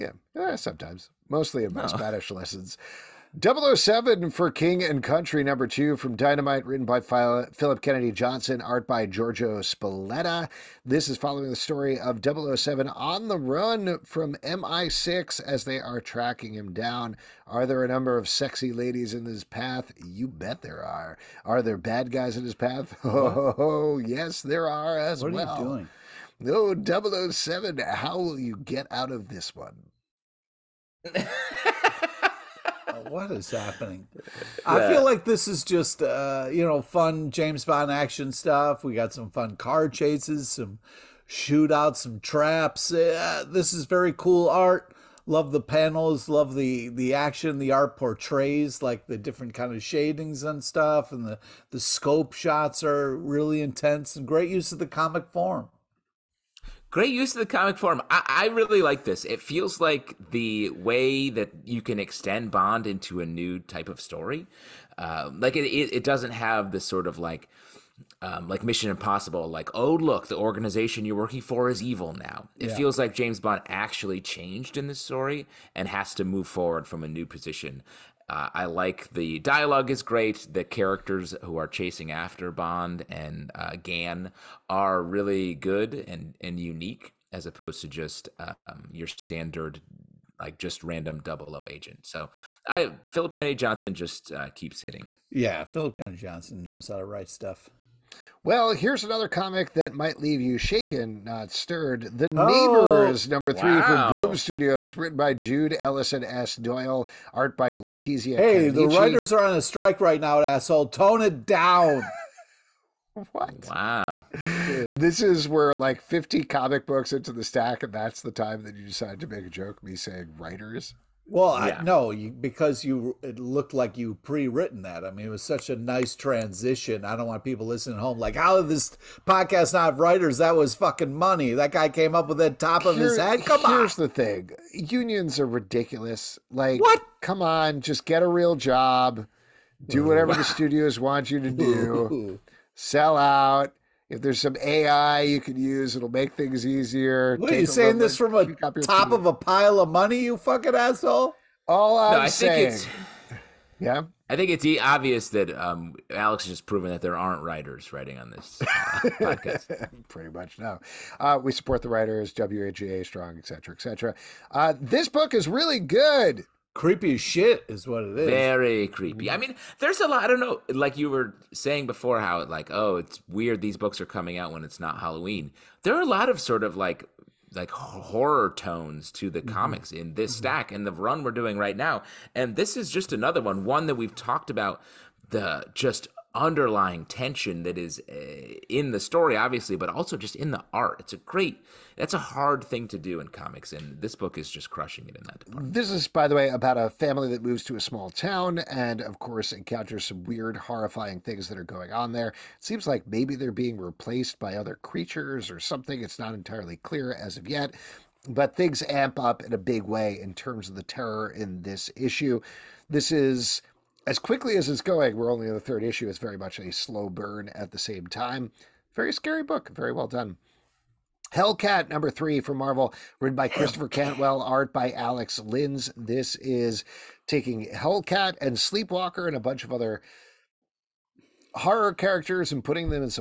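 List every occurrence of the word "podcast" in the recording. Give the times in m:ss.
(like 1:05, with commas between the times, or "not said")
2:09, 2:39.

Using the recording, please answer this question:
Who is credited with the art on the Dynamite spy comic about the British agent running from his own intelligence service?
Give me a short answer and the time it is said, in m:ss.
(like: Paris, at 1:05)
Giorgio Spalletta, at 0:09.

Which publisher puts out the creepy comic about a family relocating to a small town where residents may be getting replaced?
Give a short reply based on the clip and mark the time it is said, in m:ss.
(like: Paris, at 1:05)
Boom Studios, at 1:44.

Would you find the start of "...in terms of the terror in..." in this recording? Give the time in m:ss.
3:30.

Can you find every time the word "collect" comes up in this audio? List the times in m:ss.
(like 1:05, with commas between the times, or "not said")
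not said.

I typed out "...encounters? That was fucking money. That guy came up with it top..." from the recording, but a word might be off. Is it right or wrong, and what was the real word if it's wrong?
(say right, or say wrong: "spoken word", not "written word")
wrong: "writers", not "encounters".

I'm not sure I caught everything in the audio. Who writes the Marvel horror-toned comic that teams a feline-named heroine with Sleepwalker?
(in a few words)
Christopher Cantwell.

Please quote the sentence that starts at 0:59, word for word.
It feels like the way that you can extend Bond into a new type of story.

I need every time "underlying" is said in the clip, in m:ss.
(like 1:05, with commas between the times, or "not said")
3:06.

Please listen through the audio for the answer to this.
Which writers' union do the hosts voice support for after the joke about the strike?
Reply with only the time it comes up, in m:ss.
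2:42.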